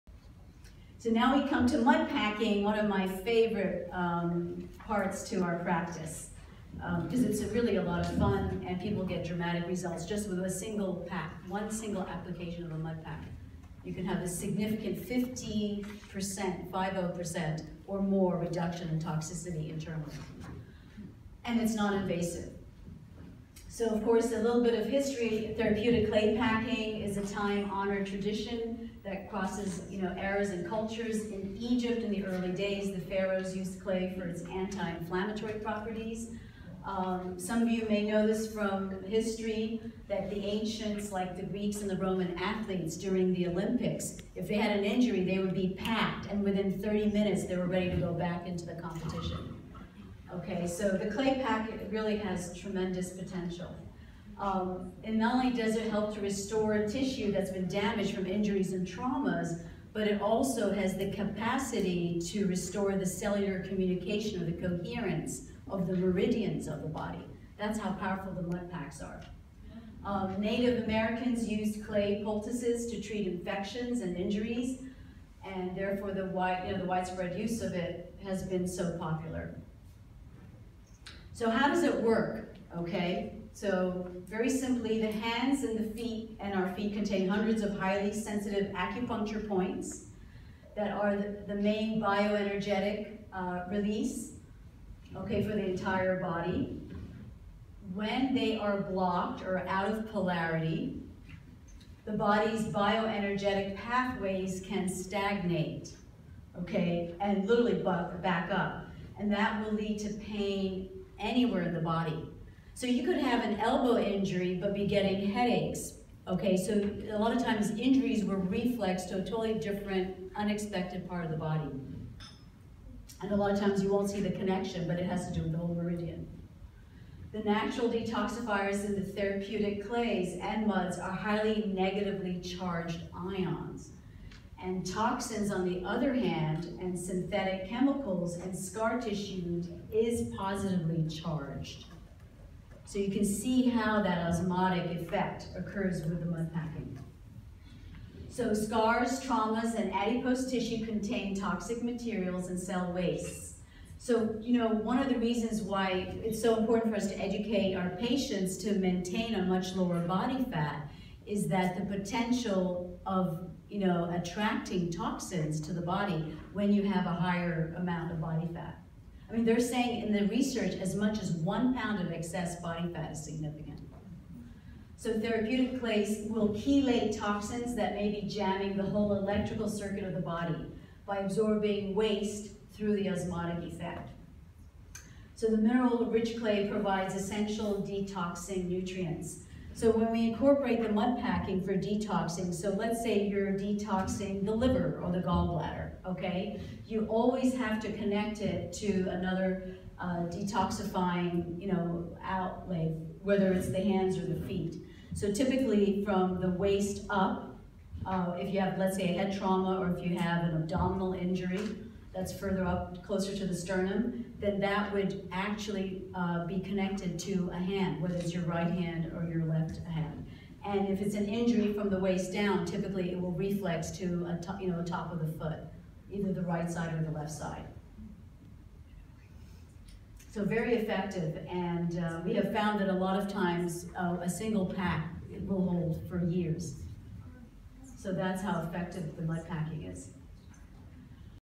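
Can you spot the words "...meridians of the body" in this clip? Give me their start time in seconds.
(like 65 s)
65 s.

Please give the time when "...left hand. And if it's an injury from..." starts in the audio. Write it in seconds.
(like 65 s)
219 s.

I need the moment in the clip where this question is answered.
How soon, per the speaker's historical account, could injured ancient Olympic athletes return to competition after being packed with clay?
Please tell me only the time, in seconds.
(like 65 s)
46 s.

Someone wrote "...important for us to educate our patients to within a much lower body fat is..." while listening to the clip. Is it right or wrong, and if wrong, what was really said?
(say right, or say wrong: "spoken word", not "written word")
wrong: "maintain", not "within".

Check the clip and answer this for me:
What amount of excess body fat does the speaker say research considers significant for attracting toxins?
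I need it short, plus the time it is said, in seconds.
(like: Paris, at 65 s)
1 pound, at 171 s.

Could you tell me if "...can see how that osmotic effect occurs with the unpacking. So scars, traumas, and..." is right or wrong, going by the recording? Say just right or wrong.
right.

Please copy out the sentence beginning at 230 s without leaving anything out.
So very effective, and uh, we have found that a lot of times uh, a single pack will hold for years.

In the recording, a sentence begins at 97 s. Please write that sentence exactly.
When they are blocked or out of polarity, the body's bioenergetic pathways can stagnate, okay, and literally back up.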